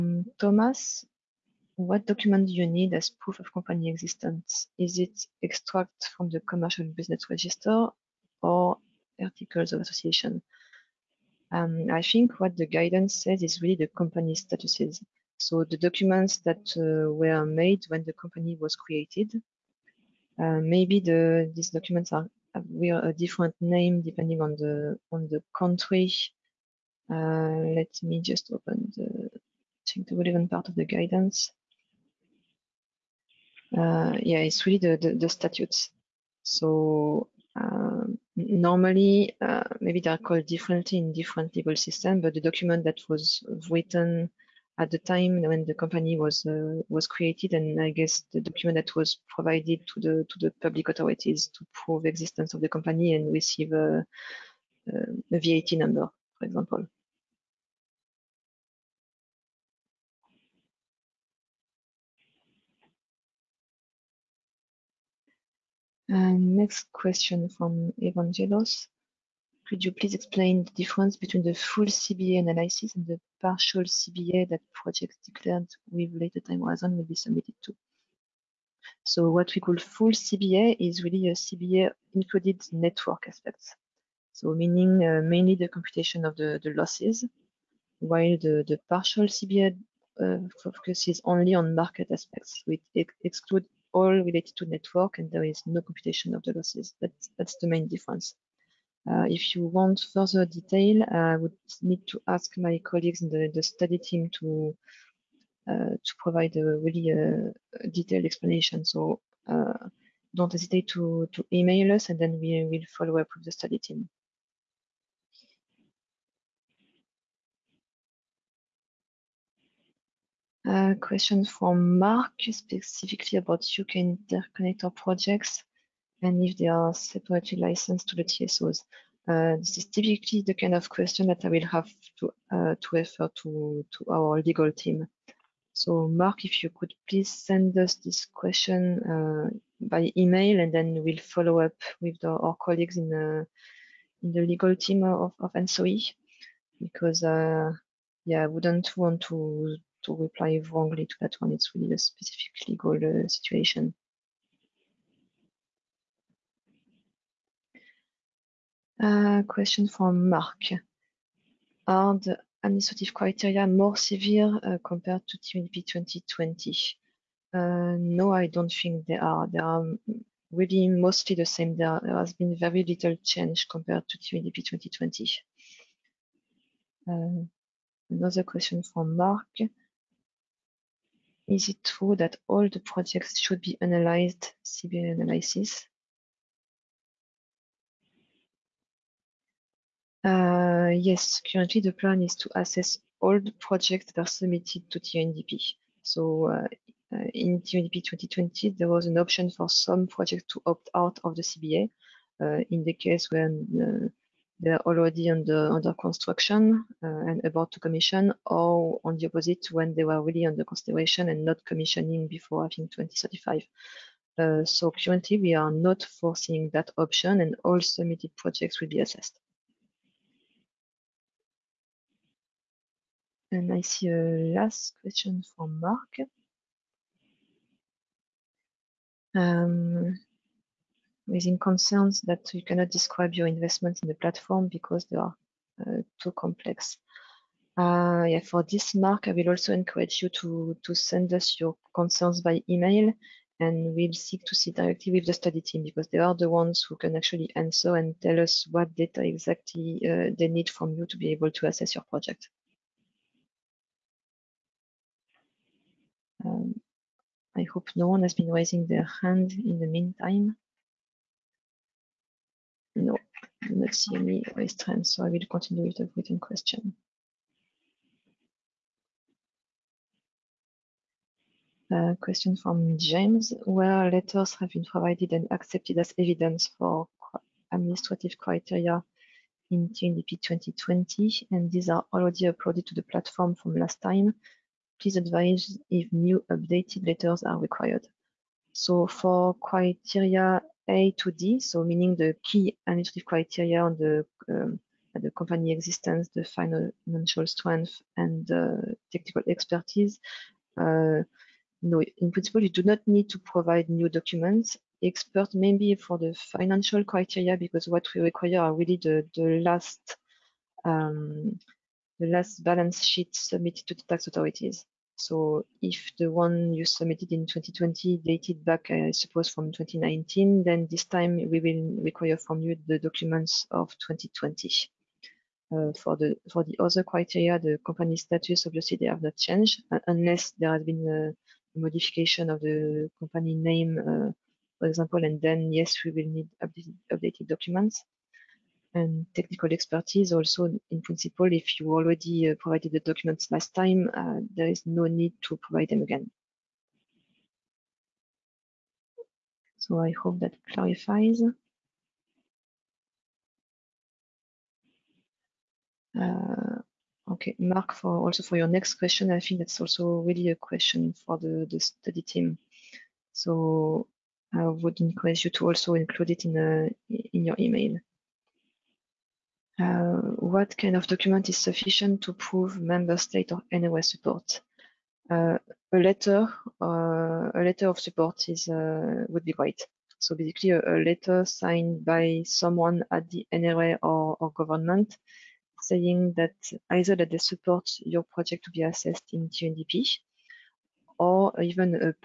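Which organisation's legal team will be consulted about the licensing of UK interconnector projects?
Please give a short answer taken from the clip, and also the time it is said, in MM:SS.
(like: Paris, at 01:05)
ENTSO-E, at 02:25.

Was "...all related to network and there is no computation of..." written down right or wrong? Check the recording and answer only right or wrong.
right.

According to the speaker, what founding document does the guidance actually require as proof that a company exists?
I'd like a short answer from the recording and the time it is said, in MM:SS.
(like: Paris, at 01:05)
statutes, at 00:35.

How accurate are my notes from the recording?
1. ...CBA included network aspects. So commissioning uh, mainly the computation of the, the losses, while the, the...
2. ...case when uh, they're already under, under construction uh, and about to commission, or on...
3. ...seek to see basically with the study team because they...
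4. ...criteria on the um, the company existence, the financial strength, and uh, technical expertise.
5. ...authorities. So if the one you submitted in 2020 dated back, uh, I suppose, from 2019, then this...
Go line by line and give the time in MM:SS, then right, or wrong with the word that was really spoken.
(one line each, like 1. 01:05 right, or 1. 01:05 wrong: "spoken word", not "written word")
1. 01:21 wrong: "meaning", not "commissioning"
2. 03:22 right
3. 04:04 wrong: "directly", not "basically"
4. 04:53 right
5. 05:14 right.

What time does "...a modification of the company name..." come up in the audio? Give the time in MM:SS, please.
05:31.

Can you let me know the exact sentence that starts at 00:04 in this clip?
Is it extract from the commercial business register or articles of association.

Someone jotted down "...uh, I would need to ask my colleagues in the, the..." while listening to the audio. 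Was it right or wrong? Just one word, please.
right.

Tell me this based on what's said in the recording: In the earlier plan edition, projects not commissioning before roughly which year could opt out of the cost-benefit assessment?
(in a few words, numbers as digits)
2035.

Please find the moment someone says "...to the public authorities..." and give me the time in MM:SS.
00:50.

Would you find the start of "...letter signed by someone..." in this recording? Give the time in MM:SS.
06:21.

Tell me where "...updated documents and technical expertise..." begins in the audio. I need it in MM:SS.
05:37.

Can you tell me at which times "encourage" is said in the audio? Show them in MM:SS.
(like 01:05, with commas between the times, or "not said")
03:59, 06:05.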